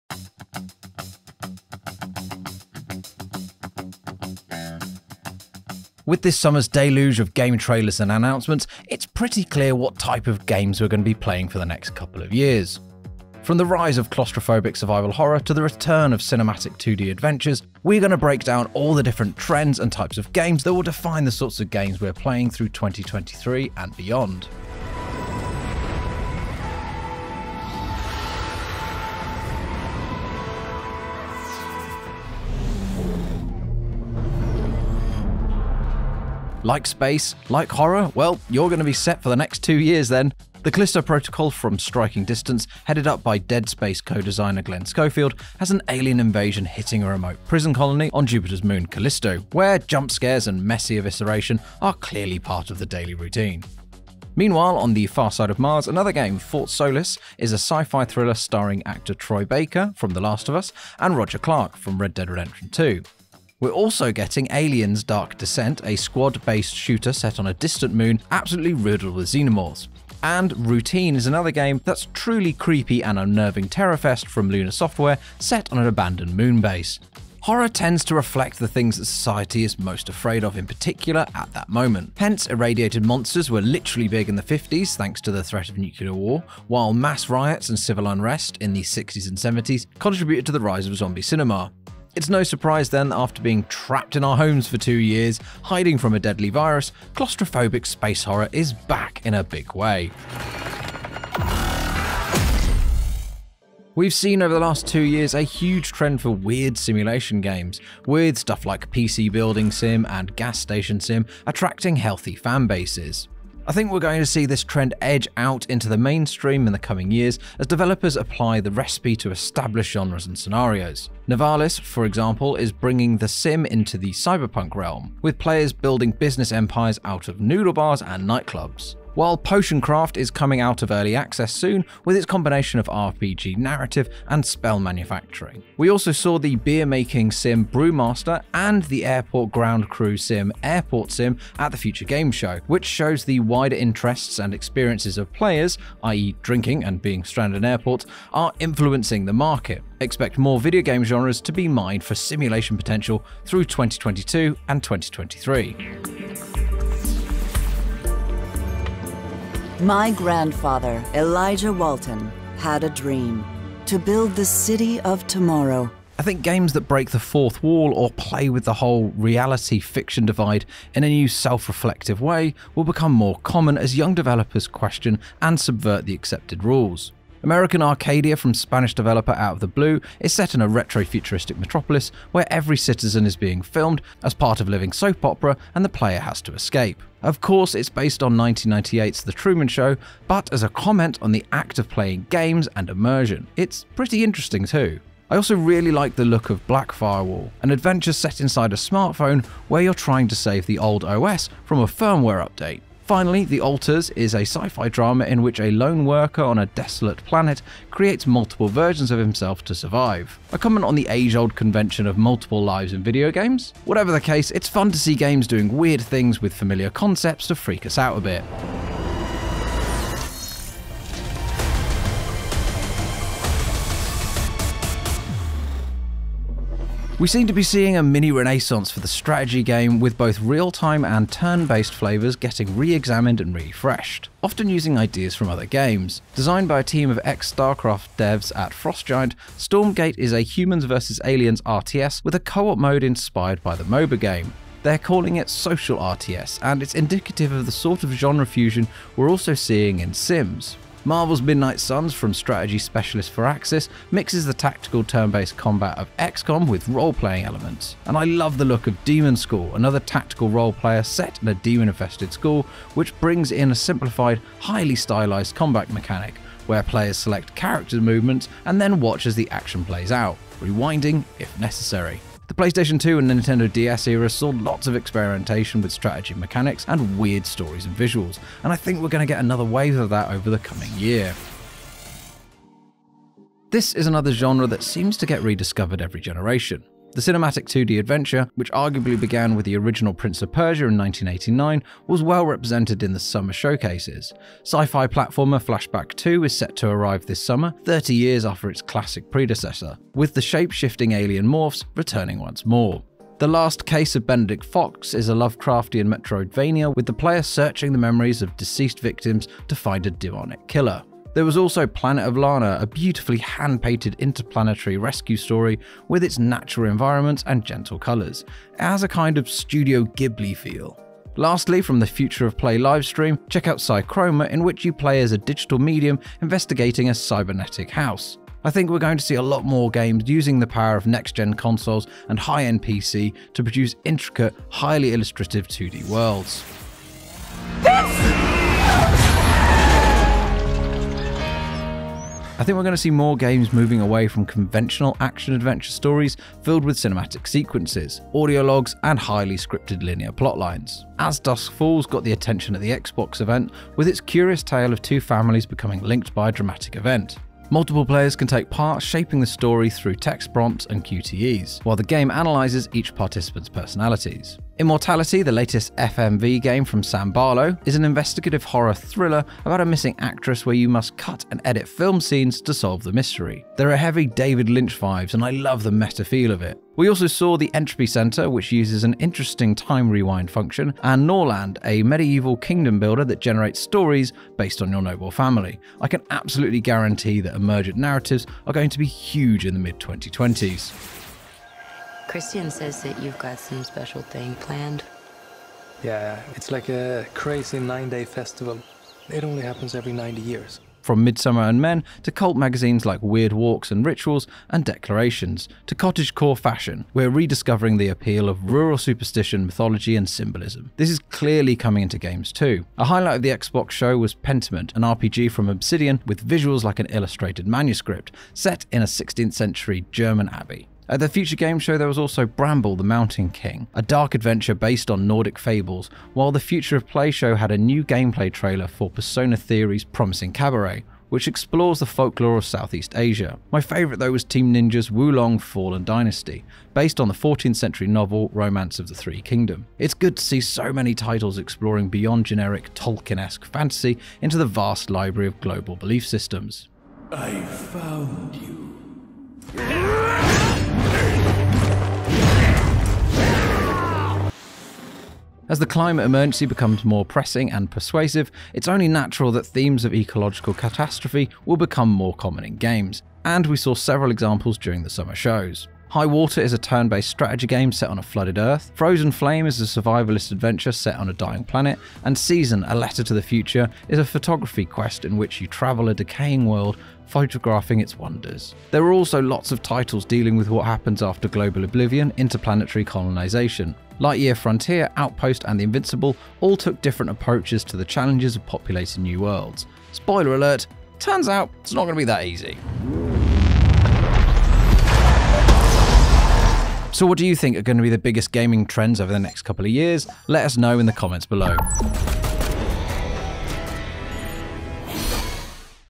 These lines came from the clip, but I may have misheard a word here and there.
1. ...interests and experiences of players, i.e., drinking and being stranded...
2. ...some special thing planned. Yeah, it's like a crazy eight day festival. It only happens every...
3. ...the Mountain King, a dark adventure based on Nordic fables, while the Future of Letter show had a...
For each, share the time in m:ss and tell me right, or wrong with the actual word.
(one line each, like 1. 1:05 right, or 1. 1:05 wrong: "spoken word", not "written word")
1. 2:23 right
2. 6:33 wrong: "nine", not "eight"
3. 7:02 wrong: "Play", not "Letter".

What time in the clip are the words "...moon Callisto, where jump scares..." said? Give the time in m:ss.
0:48.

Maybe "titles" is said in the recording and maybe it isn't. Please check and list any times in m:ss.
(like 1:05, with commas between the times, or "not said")
7:21, 7:59.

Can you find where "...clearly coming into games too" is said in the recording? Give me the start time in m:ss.
6:51.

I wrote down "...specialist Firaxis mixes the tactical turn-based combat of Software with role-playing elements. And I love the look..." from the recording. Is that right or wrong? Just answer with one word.
wrong.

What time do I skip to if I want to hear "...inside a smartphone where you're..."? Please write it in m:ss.
3:18.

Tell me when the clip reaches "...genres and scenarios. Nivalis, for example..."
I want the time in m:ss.
1:59.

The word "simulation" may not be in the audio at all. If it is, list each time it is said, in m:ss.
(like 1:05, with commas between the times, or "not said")
1:46, 2:32.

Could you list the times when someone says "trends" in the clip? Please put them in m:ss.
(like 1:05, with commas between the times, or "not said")
0:19, 1:45, 1:54, 8:18.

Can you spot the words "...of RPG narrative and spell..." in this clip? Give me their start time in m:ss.
2:12.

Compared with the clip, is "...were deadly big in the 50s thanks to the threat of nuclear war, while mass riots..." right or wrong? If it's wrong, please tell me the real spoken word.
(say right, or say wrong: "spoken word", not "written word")
wrong: "literally", not "deadly".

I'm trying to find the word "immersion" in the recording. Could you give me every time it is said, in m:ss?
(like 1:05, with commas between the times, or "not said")
3:12.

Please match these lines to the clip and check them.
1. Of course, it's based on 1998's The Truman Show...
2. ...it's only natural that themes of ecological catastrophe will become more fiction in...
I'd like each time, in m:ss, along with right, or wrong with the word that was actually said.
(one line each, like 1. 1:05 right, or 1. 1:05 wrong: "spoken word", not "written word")
1. 3:07 right
2. 7:38 wrong: "common", not "fiction".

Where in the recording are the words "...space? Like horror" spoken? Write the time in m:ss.
0:36.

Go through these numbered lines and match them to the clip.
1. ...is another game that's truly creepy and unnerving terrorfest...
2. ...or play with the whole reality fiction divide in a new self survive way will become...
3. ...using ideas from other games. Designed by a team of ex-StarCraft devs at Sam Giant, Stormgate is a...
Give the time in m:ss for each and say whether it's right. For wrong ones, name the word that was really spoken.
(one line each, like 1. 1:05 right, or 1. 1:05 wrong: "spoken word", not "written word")
1. 1:11 right
2. 2:47 wrong: "reflective", not "survive"
3. 3:54 wrong: "Frost", not "Sam".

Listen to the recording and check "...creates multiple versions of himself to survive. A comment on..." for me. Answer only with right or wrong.
right.